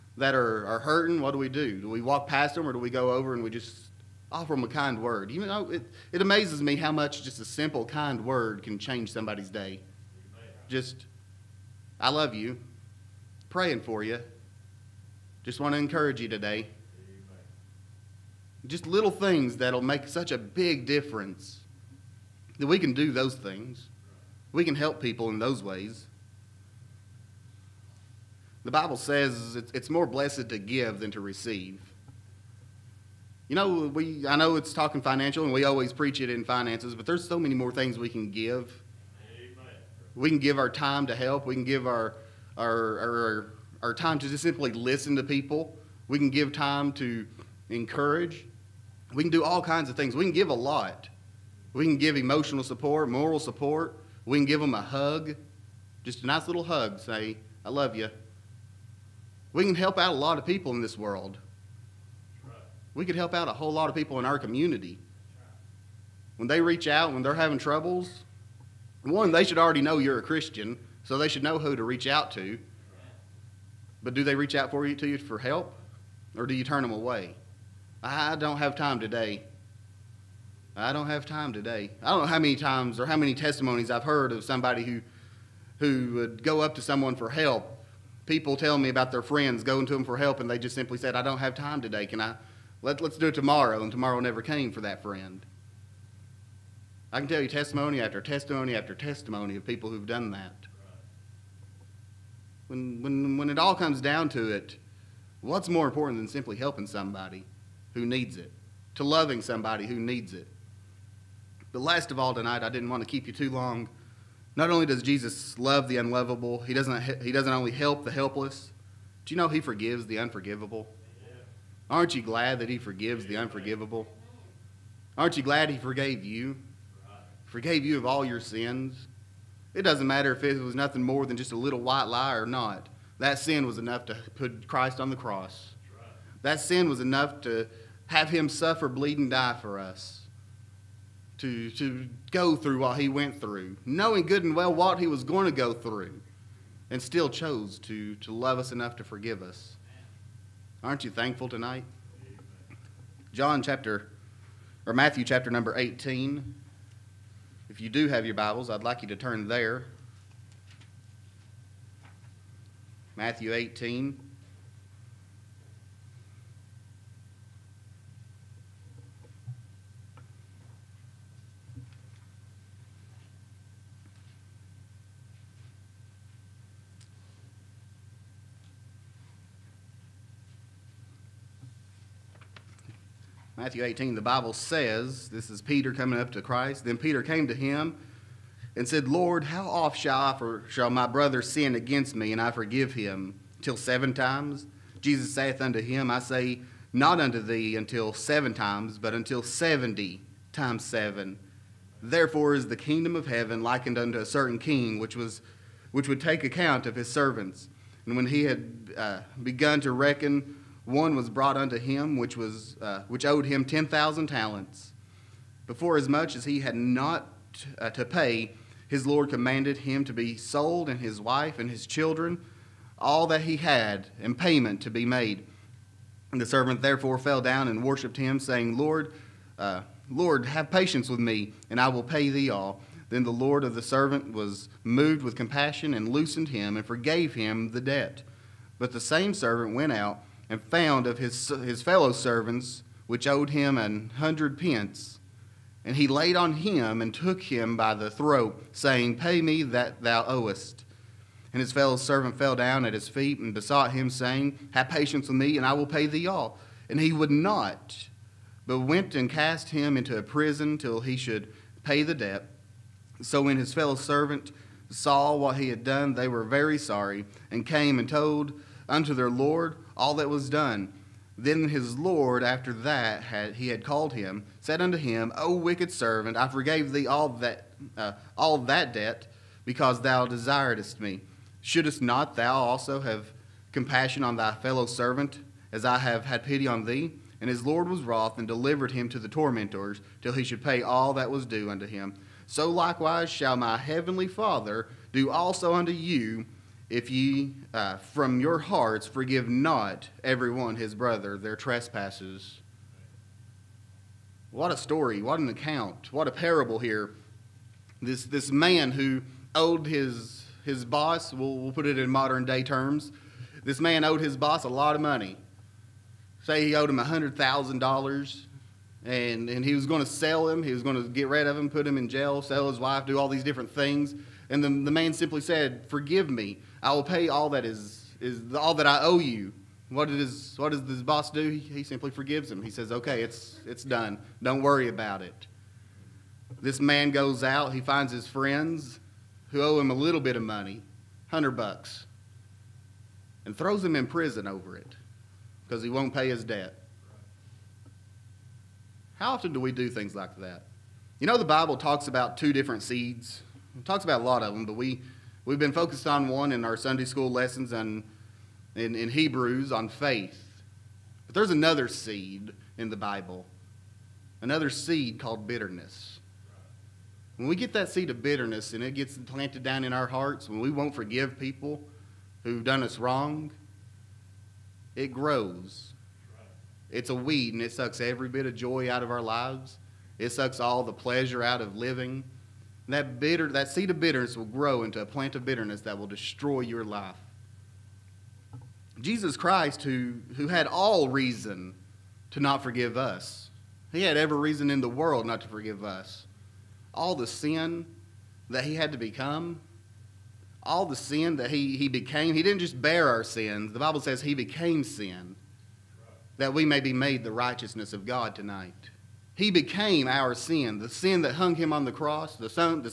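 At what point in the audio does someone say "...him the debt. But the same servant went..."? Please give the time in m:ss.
3:57.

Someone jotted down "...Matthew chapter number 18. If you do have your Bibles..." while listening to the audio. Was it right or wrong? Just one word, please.
right.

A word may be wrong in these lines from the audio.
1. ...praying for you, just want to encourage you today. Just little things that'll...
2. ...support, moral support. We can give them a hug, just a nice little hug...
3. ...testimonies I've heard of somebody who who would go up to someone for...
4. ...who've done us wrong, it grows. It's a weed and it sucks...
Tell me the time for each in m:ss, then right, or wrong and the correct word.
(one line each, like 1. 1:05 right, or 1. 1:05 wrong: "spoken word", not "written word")
1. 0:13 right
2. 0:52 right
3. 1:23 right
4. 6:12 right.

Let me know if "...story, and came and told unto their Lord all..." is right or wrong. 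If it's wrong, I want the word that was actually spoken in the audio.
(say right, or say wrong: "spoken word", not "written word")
wrong: "sorry", not "story".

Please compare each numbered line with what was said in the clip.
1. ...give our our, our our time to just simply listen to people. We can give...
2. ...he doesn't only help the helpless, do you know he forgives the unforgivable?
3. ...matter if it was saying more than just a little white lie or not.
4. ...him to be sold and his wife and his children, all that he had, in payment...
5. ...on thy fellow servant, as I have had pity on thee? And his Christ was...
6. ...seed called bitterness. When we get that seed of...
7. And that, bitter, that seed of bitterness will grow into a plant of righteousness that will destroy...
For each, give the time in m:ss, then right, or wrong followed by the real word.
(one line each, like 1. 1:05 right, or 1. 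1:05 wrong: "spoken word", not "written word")
1. 0:41 right
2. 1:57 right
3. 2:10 wrong: "nothing", not "saying"
4. 3:39 right
5. 4:44 wrong: "Lord", not "Christ"
6. 6:04 right
7. 6:22 wrong: "bitterness", not "righteousness".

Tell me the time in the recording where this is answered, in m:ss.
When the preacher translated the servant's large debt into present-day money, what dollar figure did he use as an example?
5:16.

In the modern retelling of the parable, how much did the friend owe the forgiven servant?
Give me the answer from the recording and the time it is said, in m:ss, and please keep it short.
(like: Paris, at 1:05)
100 bucks, at 5:41.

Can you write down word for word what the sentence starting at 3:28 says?
And when he had uh, begun to reckon, one was brought unto him, which, was, uh, which owed him 10,000 talents.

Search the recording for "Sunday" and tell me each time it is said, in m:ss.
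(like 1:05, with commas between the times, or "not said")
5:56.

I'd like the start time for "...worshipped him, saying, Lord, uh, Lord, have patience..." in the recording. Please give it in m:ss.
3:47.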